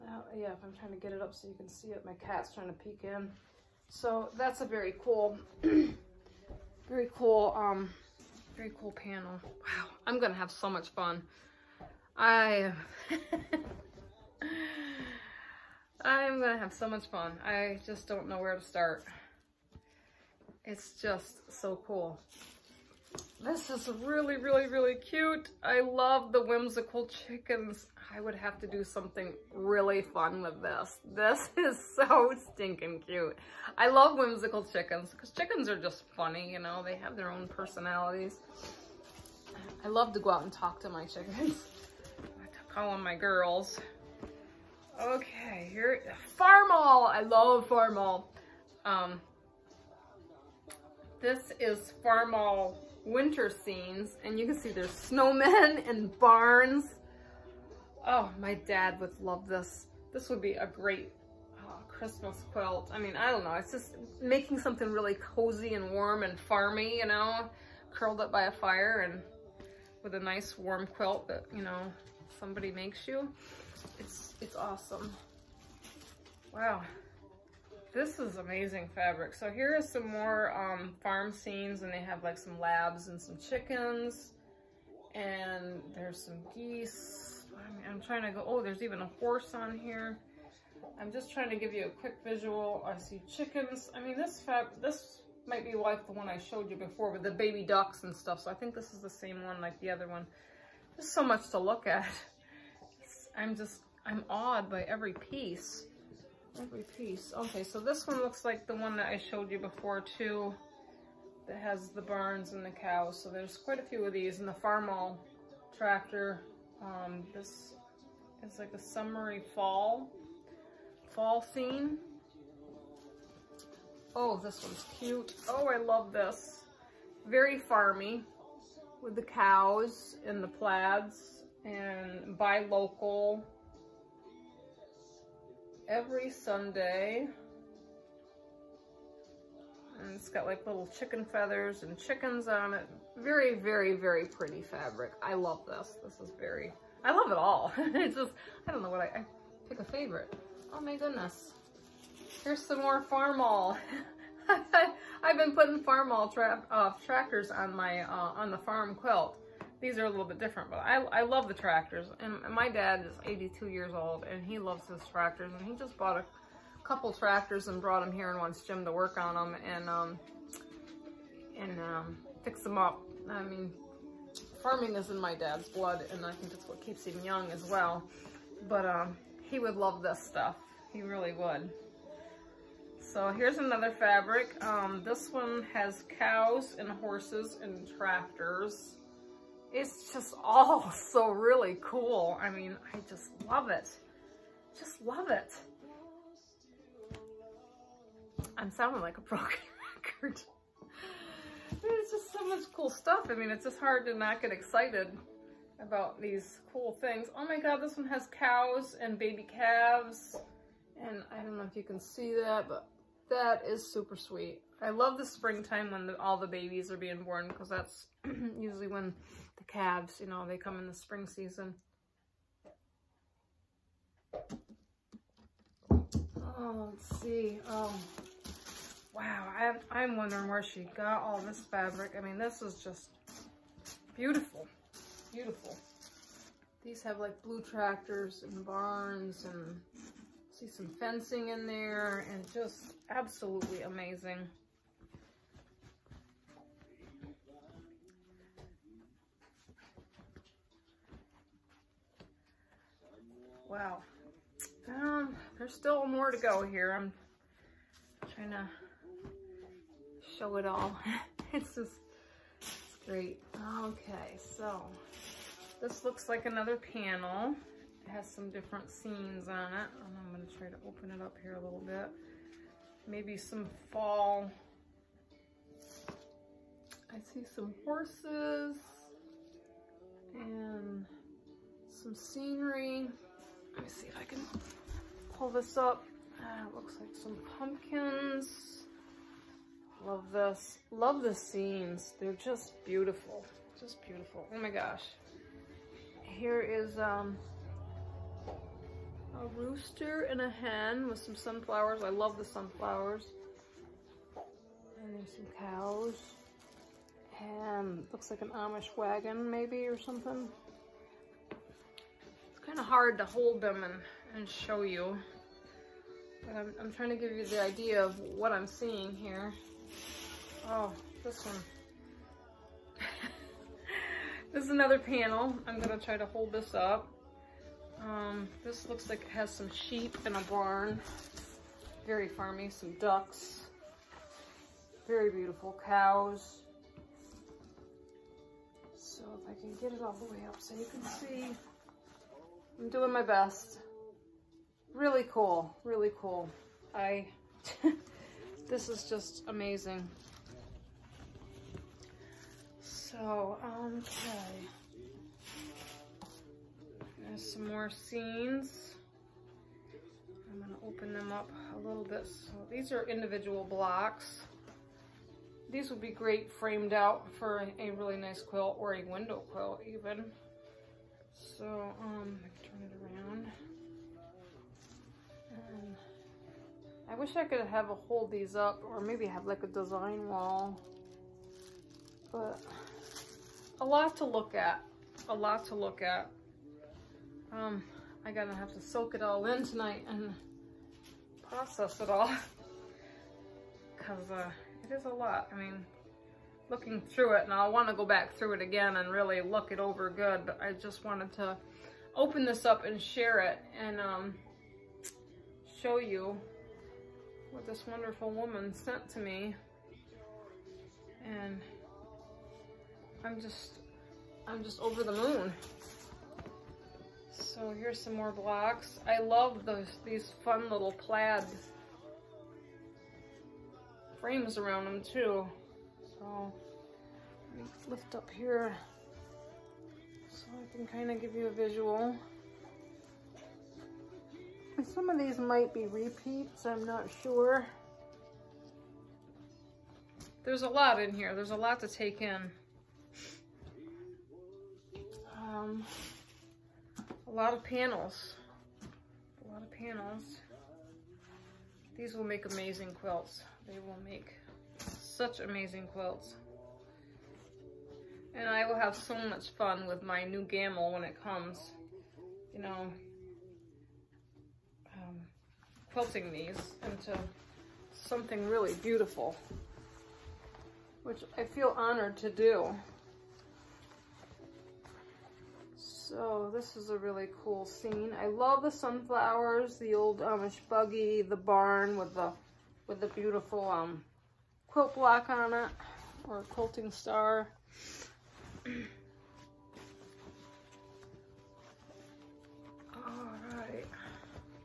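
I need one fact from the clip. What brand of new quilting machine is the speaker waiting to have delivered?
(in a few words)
Gammill.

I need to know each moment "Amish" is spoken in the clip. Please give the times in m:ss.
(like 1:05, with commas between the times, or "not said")
5:08, 8:00.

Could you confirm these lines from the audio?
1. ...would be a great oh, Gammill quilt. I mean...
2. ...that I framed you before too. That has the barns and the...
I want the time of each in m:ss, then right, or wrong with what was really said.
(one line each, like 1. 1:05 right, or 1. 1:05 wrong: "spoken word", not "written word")
1. 1:00 wrong: "Christmas", not "Gammill"
2. 1:48 wrong: "showed", not "framed".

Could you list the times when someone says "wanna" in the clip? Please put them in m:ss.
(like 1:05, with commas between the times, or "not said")
6:37.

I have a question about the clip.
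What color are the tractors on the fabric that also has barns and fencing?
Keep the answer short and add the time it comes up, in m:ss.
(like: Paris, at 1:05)
Blue, at 3:57.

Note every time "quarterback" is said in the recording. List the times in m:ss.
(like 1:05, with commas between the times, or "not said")
not said.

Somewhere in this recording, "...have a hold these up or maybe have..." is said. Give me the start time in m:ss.
6:17.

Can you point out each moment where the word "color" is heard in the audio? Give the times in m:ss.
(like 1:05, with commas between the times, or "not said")
not said.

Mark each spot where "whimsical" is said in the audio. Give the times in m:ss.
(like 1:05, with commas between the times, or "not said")
0:26, 0:34.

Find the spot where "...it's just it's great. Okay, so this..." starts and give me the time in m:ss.
4:21.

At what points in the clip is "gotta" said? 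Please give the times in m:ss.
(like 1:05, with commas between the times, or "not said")
6:28.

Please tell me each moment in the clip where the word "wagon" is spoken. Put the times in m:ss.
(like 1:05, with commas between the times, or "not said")
5:08.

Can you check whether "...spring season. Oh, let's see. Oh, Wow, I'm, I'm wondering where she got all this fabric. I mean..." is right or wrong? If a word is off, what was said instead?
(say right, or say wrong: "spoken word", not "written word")
right.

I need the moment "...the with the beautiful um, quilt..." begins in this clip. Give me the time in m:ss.
8:02.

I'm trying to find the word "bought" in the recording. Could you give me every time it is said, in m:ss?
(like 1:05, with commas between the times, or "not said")
2:45.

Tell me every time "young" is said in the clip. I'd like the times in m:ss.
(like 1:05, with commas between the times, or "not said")
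2:57.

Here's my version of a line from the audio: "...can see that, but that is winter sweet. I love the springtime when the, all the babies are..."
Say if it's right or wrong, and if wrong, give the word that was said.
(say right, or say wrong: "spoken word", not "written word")
wrong: "super", not "winter".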